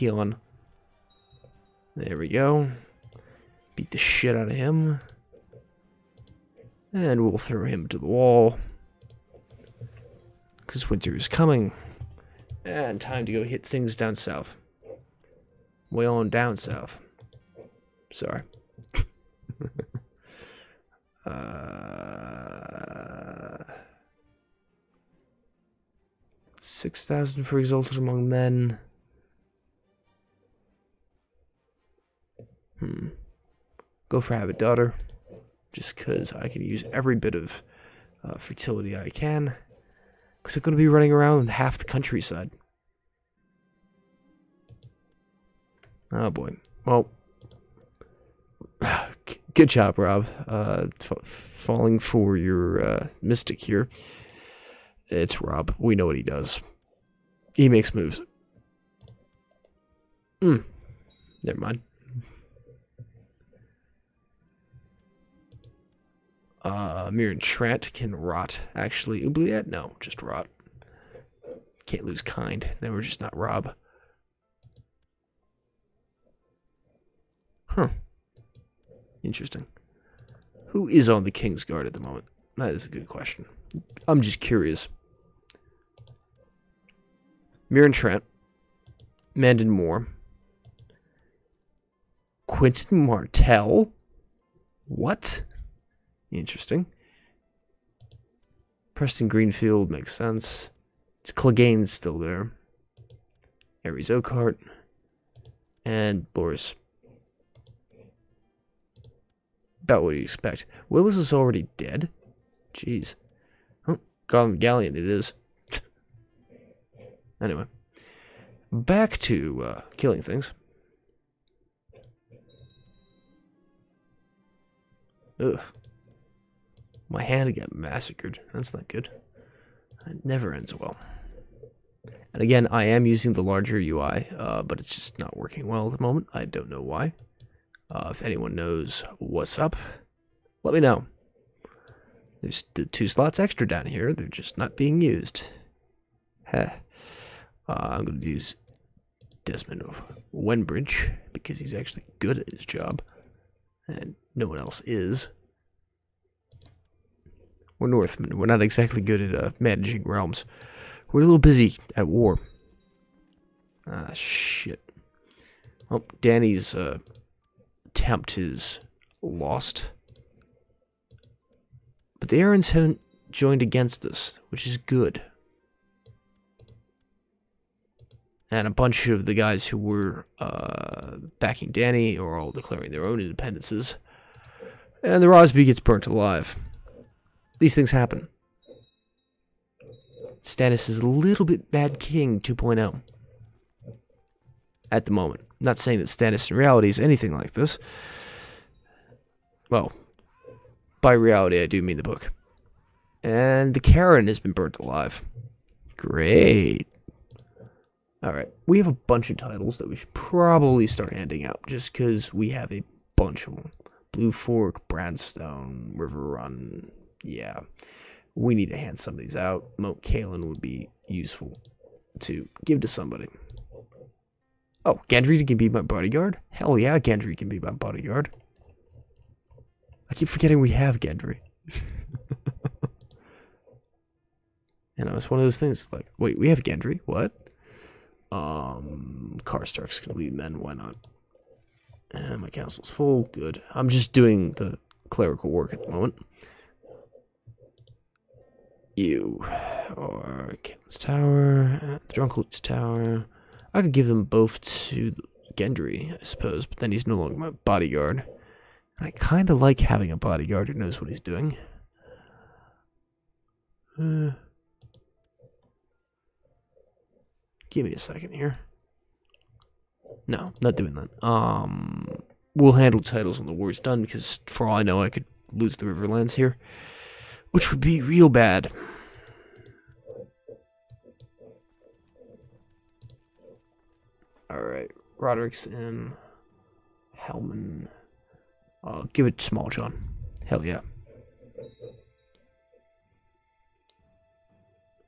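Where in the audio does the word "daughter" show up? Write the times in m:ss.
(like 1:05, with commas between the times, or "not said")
0:34.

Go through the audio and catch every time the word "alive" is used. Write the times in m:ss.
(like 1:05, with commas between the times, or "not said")
3:06, 3:24.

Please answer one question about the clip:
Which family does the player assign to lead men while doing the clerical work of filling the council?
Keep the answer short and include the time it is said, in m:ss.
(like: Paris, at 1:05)
Karstark, at 3:59.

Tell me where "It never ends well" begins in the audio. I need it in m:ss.
2:10.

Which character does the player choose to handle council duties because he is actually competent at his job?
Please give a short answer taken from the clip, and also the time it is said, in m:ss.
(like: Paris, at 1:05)
Desmond of Wenbridge, at 2:29.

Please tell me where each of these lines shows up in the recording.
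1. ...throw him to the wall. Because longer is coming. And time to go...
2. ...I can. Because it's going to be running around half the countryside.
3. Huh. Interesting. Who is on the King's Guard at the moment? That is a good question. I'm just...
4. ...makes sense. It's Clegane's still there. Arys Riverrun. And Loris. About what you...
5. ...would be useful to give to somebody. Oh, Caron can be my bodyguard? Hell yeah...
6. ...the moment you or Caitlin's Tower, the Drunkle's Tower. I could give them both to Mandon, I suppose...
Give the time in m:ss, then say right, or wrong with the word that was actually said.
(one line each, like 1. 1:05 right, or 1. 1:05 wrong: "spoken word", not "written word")
1. 0:07 wrong: "winter", not "longer"
2. 0:38 right
3. 1:17 right
4. 1:39 wrong: "Oakheart", not "Riverrun"
5. 3:40 wrong: "Gendry", not "Caron"
6. 4:05 wrong: "Gendry", not "Mandon".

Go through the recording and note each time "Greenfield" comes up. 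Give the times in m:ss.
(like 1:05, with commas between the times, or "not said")
1:39.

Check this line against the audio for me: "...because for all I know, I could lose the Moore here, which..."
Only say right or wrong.
wrong.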